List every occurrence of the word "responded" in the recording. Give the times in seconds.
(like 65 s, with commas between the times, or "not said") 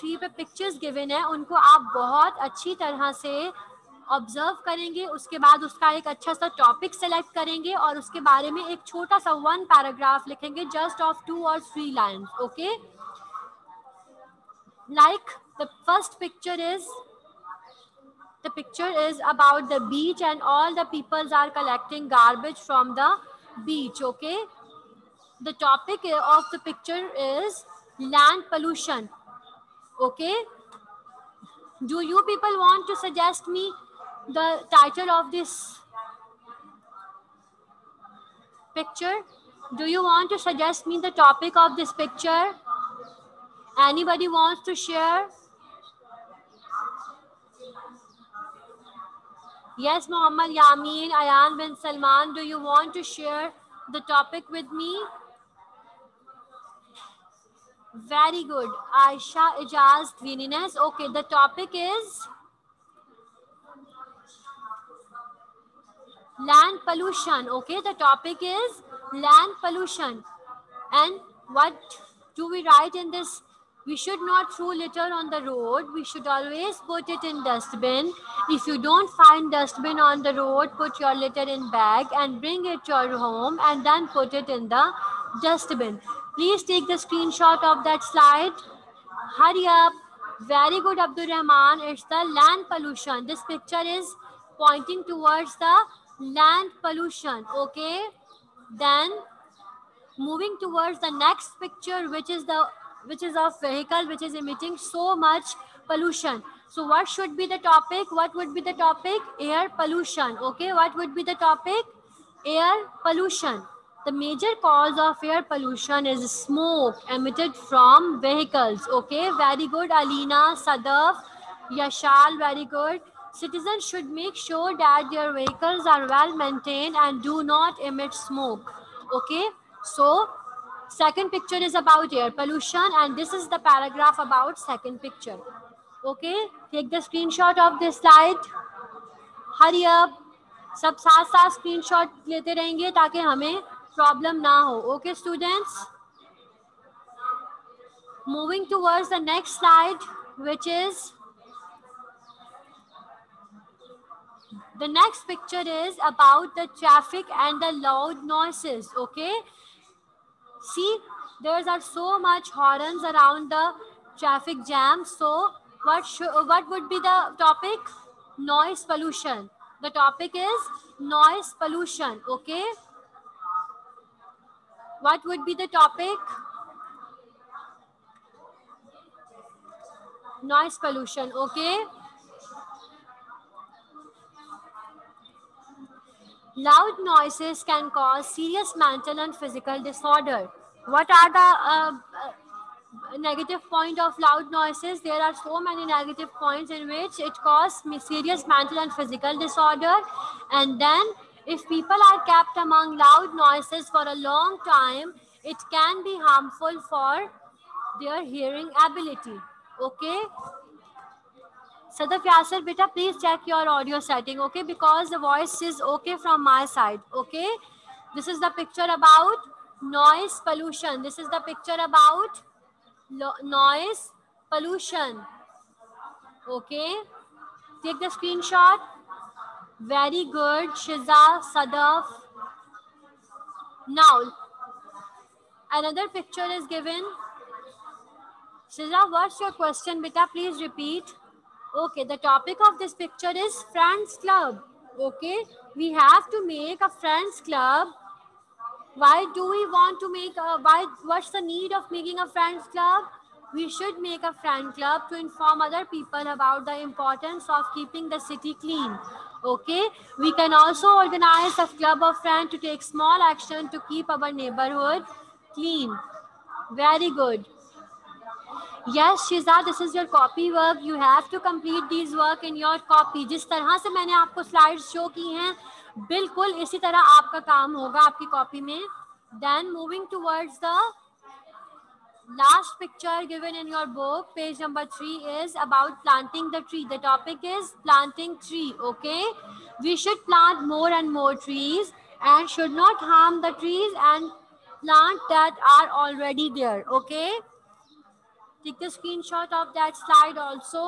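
not said.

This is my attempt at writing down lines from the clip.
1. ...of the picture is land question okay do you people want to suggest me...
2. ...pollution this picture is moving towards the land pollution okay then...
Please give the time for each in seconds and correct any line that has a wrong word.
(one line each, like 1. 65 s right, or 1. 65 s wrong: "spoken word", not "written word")
1. 26 s wrong: "pollution", not "question"
2. 92 s wrong: "pointing", not "moving".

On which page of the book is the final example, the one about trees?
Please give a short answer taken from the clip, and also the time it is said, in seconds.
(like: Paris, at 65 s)
3, at 284 s.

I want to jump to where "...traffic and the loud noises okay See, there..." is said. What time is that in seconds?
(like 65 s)
156 s.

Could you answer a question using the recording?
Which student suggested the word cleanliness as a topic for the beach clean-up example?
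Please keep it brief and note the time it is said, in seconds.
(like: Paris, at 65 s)
Aisha Ijaz, at 59 s.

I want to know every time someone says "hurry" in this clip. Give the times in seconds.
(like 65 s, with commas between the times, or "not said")
89 s, 139 s.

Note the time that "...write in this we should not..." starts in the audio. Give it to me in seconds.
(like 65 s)
72 s.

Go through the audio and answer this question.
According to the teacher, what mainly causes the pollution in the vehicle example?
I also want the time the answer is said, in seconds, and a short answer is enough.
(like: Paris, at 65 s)
Smoke emitted from vehicles, at 116 s.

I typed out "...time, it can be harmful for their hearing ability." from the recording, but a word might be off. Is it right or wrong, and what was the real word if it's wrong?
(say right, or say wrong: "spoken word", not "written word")
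right.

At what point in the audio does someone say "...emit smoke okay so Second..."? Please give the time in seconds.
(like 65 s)
127 s.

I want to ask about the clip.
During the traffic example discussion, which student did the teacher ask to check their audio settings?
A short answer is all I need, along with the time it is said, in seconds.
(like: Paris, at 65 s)
Sadaf Yasser, at 211 s.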